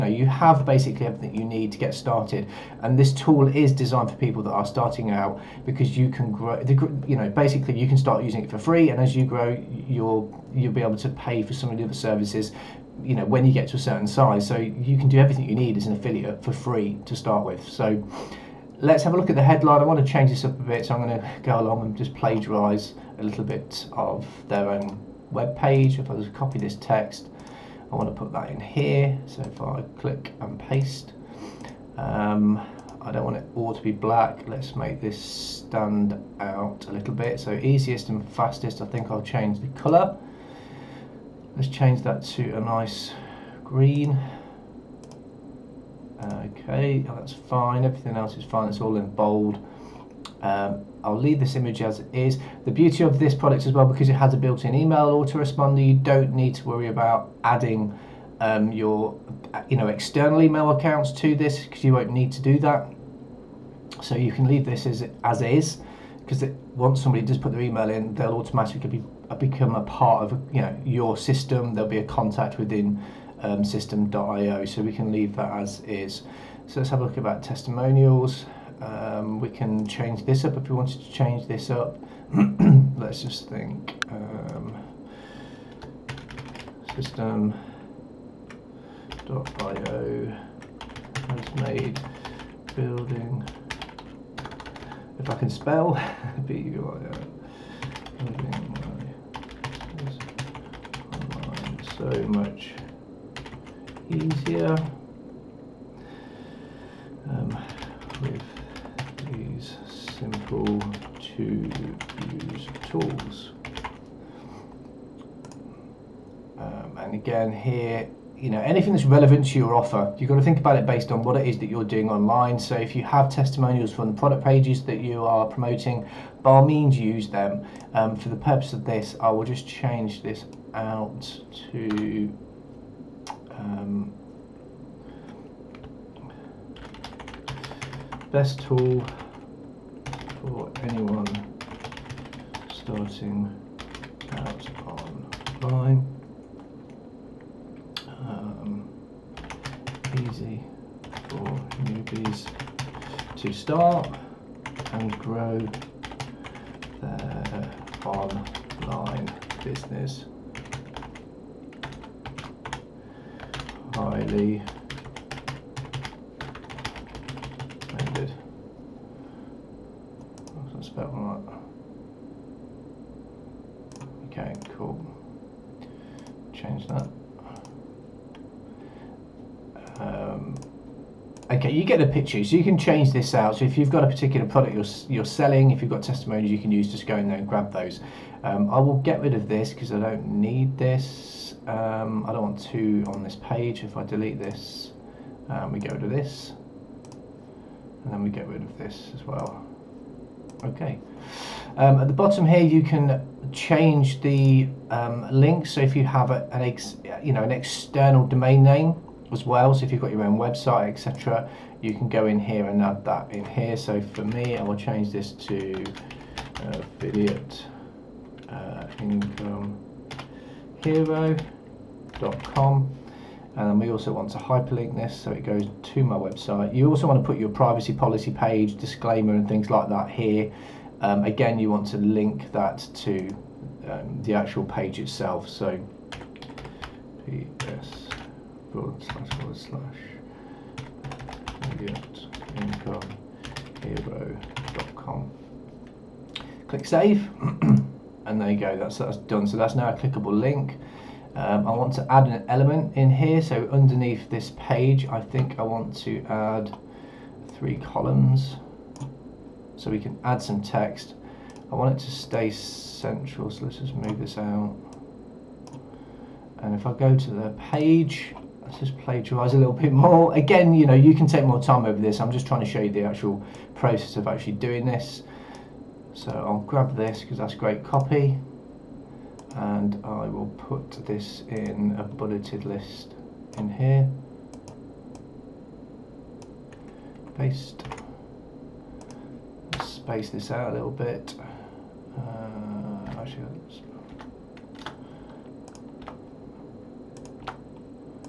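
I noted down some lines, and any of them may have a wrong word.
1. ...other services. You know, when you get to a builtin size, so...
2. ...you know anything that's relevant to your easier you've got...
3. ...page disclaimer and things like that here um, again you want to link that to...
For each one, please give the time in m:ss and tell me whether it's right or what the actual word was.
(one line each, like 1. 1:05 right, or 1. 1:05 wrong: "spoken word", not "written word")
1. 0:11 wrong: "certain", not "builtin"
2. 1:58 wrong: "offer", not "easier"
3. 3:48 right.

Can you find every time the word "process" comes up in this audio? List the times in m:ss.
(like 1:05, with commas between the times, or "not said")
4:33.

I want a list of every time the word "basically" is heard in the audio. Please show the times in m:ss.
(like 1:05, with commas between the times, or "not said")
0:00, 0:07.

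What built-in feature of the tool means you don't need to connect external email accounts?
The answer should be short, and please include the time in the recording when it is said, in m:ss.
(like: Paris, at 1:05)
email autoresponder, at 0:54.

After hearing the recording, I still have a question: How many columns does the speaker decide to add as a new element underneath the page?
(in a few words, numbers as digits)
3.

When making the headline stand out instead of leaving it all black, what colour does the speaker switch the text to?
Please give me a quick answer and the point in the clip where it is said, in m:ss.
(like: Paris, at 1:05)
green, at 0:43.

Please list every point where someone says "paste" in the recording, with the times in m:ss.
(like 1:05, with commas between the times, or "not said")
0:30, 4:47.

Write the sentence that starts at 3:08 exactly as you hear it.
Um, I will get rid of this because I don't need this.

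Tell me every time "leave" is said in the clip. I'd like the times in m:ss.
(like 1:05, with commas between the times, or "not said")
0:51, 1:04, 1:15.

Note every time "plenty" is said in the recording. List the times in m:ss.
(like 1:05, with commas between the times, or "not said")
not said.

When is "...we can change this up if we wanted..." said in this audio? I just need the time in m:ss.
1:19.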